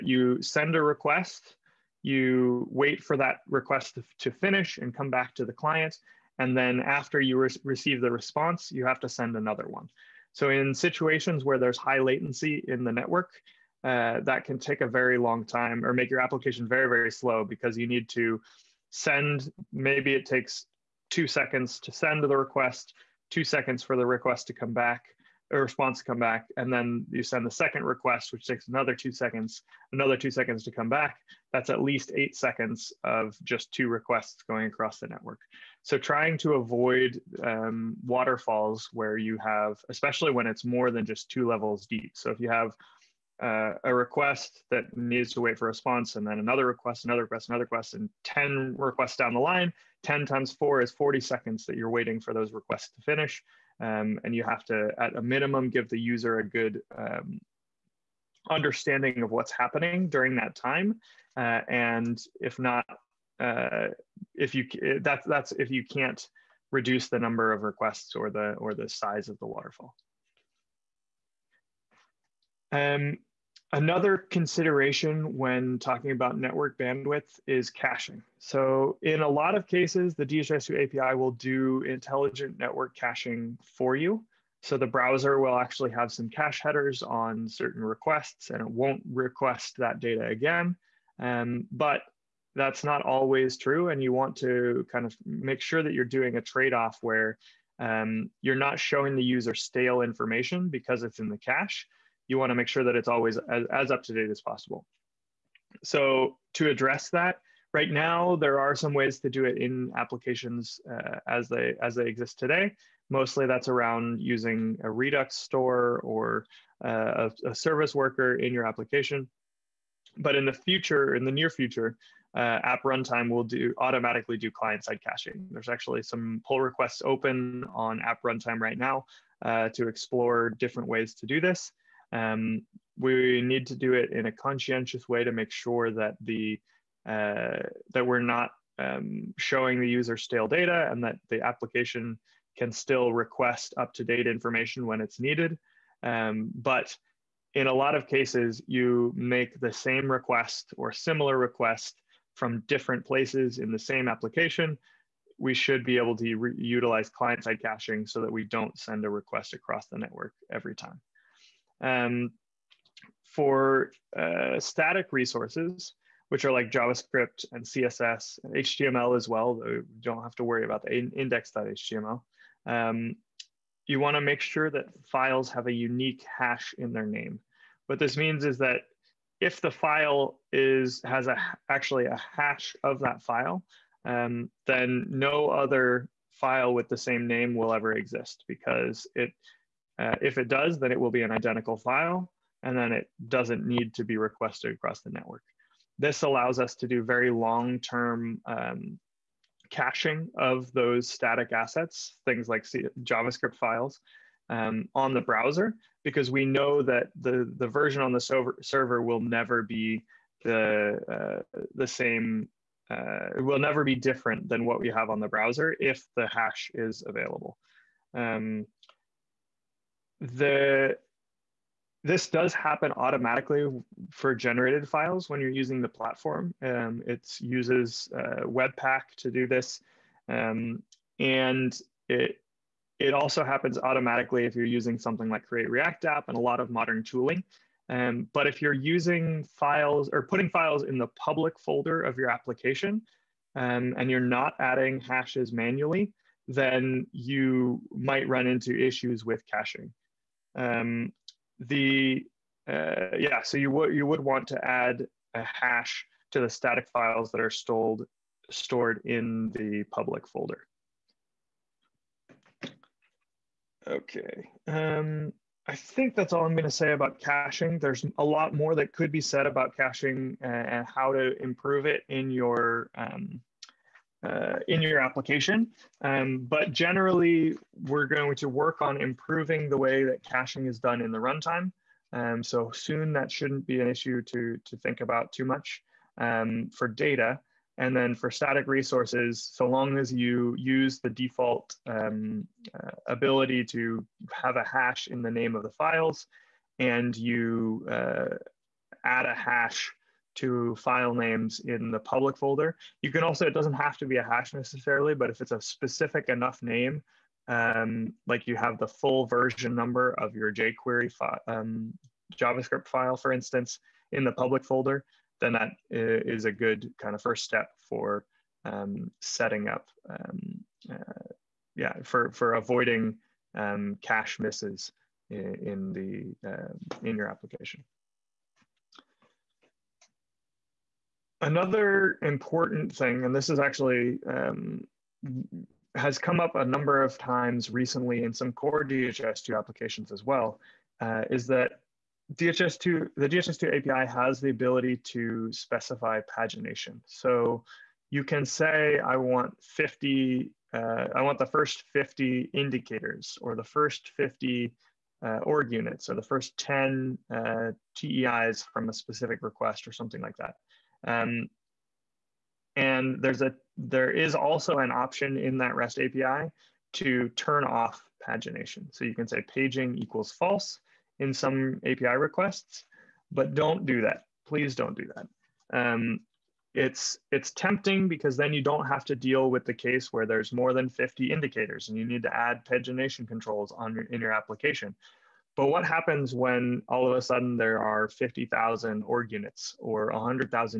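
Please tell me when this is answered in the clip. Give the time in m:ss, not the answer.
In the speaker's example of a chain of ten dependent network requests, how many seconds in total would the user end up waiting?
0:50.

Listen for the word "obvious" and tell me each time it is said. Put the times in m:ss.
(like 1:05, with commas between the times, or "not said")
not said.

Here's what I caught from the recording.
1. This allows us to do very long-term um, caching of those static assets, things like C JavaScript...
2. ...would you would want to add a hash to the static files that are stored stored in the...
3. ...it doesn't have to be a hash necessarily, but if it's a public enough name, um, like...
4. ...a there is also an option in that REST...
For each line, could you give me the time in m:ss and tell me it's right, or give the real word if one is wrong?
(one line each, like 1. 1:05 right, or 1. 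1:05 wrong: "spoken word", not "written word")
1. 3:15 right
2. 4:13 right
3. 5:03 wrong: "specific", not "public"
4. 6:03 right.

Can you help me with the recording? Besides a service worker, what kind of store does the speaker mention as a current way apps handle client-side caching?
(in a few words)
Redux store.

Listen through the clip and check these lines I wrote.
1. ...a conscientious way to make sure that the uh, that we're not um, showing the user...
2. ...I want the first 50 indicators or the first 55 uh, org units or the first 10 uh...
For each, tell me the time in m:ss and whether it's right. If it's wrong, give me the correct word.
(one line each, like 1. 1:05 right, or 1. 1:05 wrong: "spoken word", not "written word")
1. 2:14 right
2. 5:51 wrong: "50", not "55".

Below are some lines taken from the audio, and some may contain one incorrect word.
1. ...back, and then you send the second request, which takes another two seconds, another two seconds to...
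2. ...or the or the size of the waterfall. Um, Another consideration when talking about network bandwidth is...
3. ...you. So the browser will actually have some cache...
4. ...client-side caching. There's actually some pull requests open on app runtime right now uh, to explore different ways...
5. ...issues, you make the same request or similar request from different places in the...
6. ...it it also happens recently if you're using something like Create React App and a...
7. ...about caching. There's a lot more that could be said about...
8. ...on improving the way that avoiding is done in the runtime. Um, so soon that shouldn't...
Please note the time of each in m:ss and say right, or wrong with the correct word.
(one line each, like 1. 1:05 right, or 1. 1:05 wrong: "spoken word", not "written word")
1. 0:26 right
2. 1:08 right
3. 1:23 right
4. 2:04 right
5. 2:28 wrong: "cases", not "issues"
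6. 3:52 wrong: "automatically", not "recently"
7. 4:26 right
8. 4:38 wrong: "caching", not "avoiding".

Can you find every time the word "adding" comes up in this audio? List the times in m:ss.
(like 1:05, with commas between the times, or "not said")
4:04.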